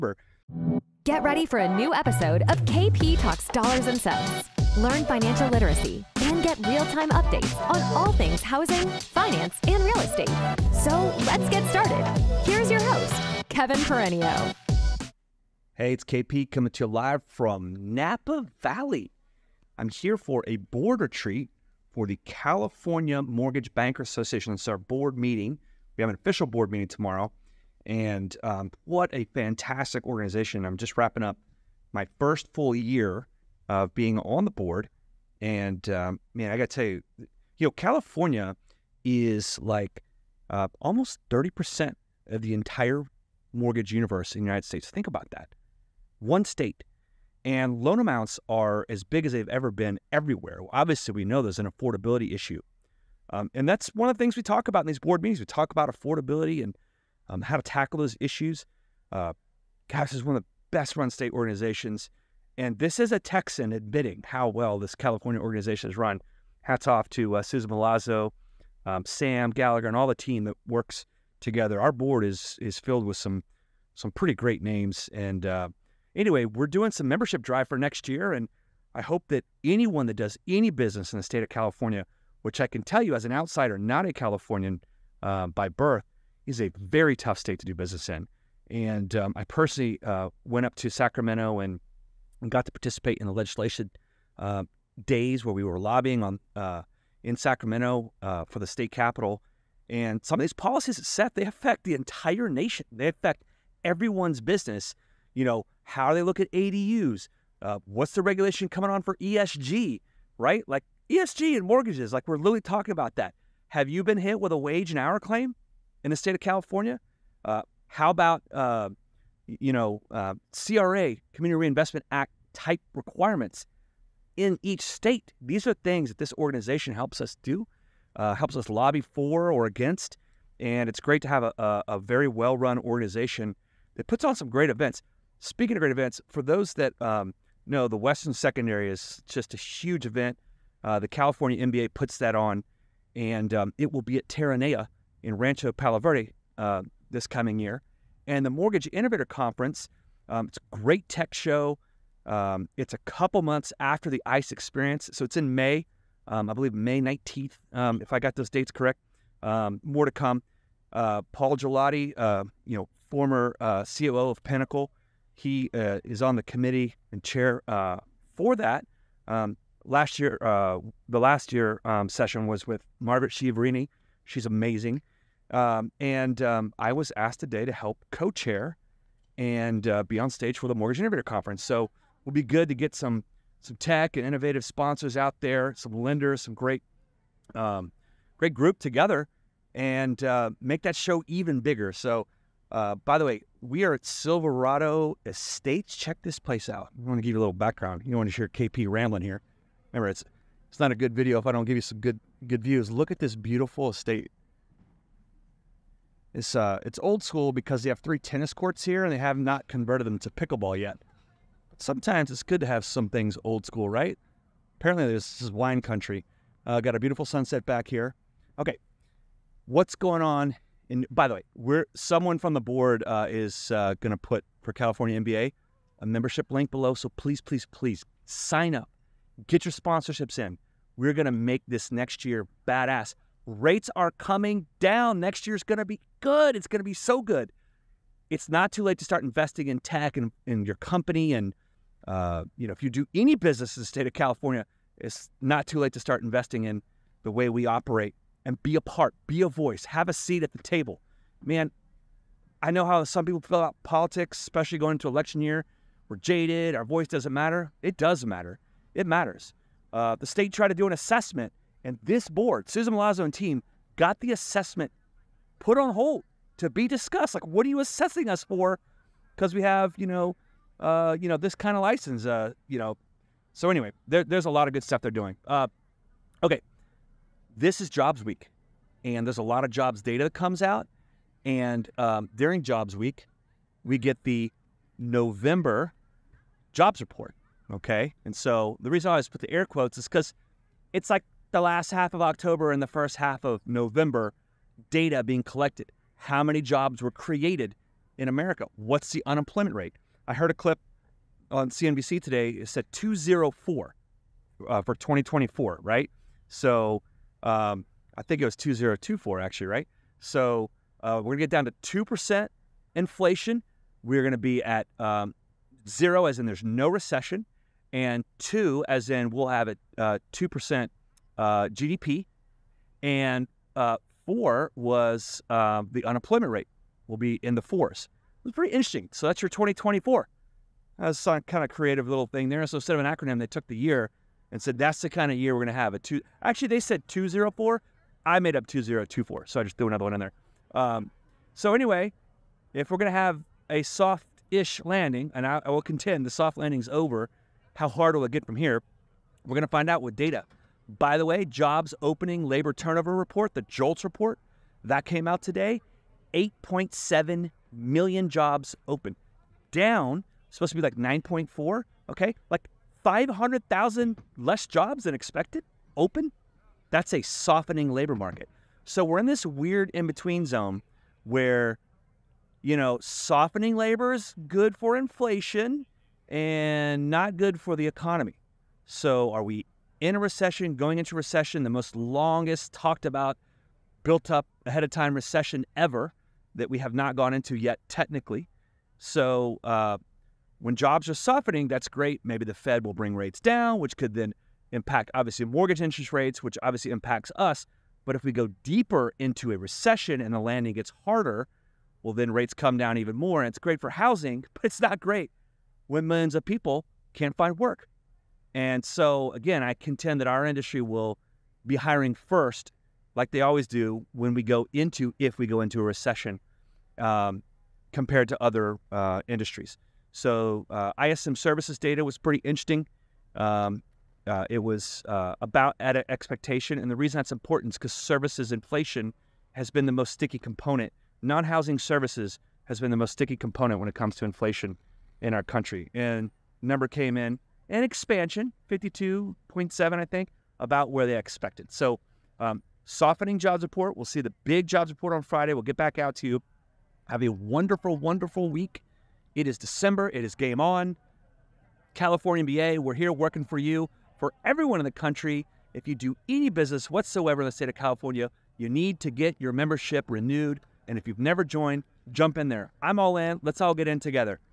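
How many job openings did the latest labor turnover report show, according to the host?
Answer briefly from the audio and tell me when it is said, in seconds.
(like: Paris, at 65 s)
8.7 million, at 356 s.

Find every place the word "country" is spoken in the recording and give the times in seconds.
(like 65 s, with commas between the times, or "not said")
215 s, 435 s, 454 s.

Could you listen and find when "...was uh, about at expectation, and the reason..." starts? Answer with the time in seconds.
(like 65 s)
424 s.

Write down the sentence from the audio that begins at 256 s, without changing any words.
We're jaded, our voice doesn't matter.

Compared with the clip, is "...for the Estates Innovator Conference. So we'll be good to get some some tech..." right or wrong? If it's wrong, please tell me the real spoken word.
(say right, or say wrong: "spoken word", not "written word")
wrong: "Mortgage", not "Estates".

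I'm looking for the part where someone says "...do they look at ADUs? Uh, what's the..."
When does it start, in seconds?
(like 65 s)
106 s.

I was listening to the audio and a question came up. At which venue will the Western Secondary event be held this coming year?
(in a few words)
Terranea.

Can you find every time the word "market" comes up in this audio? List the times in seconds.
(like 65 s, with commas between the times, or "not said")
368 s.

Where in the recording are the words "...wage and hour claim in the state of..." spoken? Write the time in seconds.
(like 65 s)
114 s.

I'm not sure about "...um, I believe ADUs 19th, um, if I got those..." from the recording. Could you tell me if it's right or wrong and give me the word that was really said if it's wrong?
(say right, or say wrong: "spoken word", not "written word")
wrong: "May", not "ADUs".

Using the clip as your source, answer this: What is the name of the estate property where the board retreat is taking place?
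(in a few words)
Silverado Estates.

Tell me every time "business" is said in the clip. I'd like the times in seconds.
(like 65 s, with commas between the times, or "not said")
80 s, 87 s, 104 s, 243 s, 456 s.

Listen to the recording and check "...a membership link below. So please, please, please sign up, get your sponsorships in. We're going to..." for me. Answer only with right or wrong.
right.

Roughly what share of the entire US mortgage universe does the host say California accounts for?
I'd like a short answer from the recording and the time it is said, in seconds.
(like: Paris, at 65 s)
almost 30%, at 40 s.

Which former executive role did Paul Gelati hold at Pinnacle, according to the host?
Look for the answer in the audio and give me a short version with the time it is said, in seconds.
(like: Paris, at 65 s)
COO, at 163 s.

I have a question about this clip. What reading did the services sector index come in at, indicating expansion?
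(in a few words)
52.7.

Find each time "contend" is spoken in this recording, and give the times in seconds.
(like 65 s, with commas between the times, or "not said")
345 s, 409 s.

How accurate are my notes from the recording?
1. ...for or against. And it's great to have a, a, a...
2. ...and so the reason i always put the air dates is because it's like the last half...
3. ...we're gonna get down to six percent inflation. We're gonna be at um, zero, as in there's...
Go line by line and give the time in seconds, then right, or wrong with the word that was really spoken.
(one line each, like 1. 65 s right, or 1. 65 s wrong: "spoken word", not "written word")
1. 128 s right
2. 288 s wrong: "quotes", not "dates"
3. 311 s wrong: "two", not "six".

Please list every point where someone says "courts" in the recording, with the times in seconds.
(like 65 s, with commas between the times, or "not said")
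208 s.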